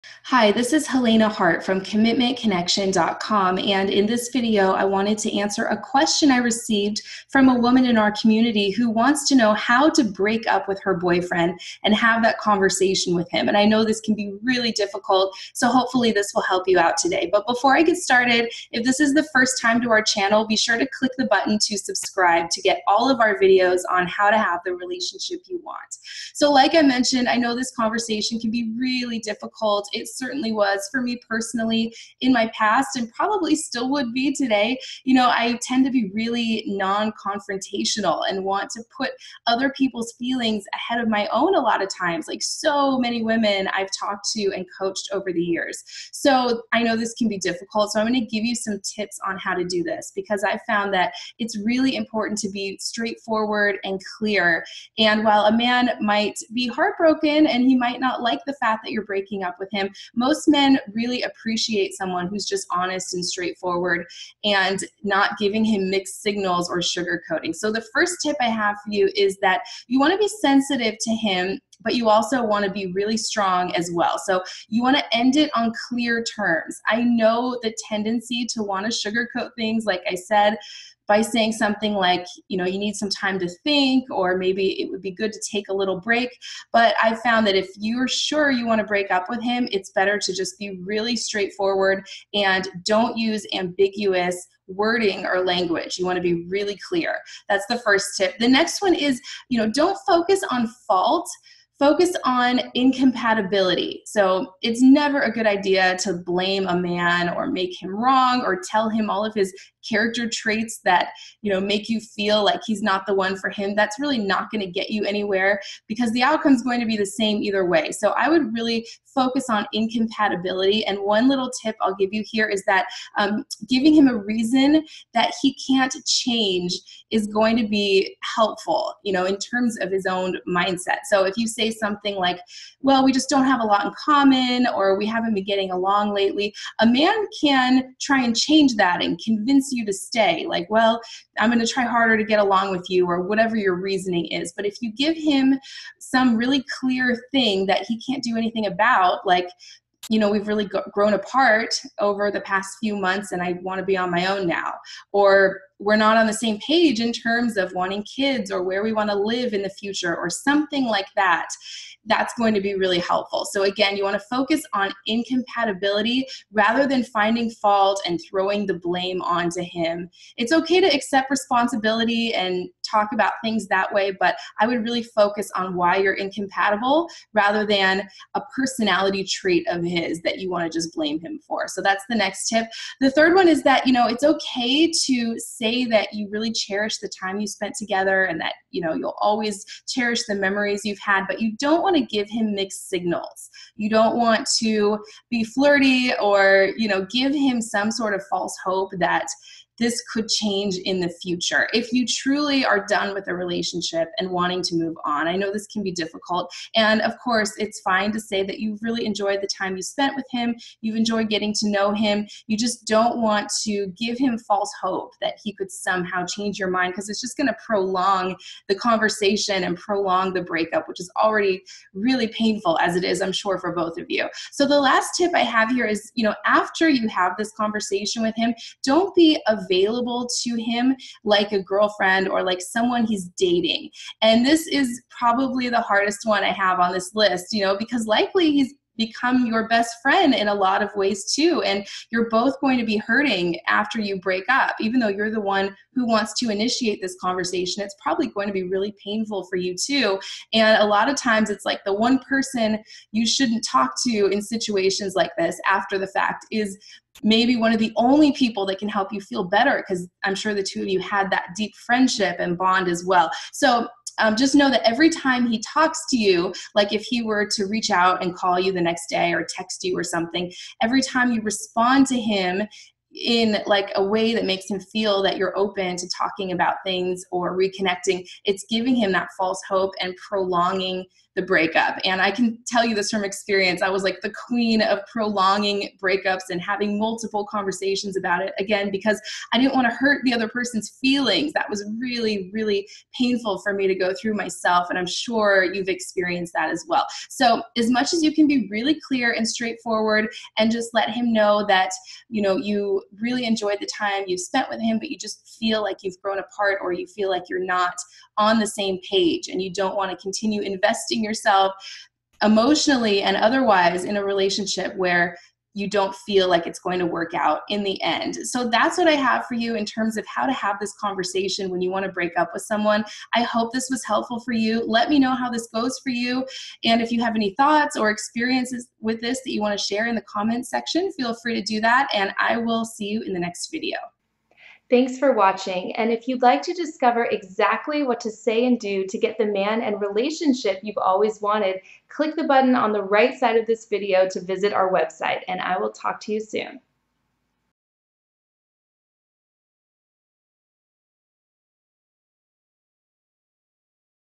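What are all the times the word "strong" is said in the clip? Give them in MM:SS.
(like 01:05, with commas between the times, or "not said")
01:13.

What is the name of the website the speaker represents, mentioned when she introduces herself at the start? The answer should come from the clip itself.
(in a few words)
commitmentconnection.com.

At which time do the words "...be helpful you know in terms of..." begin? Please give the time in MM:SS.
02:07.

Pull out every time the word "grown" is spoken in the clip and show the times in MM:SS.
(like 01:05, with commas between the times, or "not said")
02:30, 05:06.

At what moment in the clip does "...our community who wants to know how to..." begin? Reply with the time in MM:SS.
00:07.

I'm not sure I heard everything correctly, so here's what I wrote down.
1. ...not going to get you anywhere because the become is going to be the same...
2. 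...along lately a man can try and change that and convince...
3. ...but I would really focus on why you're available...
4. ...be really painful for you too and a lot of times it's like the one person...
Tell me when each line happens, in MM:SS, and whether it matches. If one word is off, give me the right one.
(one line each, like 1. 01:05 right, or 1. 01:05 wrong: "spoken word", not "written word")
1. 01:54 wrong: "outcome", not "become"
2. 02:15 right
3. 02:54 wrong: "incompatible", not "available"
4. 04:08 right.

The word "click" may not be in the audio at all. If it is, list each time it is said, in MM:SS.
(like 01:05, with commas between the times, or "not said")
00:20, 05:42.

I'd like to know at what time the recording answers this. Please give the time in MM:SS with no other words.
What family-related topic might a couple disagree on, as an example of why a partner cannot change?
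02:37.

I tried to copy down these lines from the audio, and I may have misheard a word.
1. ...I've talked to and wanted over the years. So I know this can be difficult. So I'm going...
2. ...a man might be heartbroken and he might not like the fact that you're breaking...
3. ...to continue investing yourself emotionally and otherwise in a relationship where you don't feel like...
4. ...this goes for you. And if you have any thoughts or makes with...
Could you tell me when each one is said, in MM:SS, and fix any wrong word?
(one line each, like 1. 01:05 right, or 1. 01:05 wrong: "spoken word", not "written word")
1. 00:43 wrong: "coached", not "wanted"
2. 00:55 right
3. 05:10 right
4. 05:25 wrong: "experiences", not "makes".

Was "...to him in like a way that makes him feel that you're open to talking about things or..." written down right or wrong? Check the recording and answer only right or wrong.
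right.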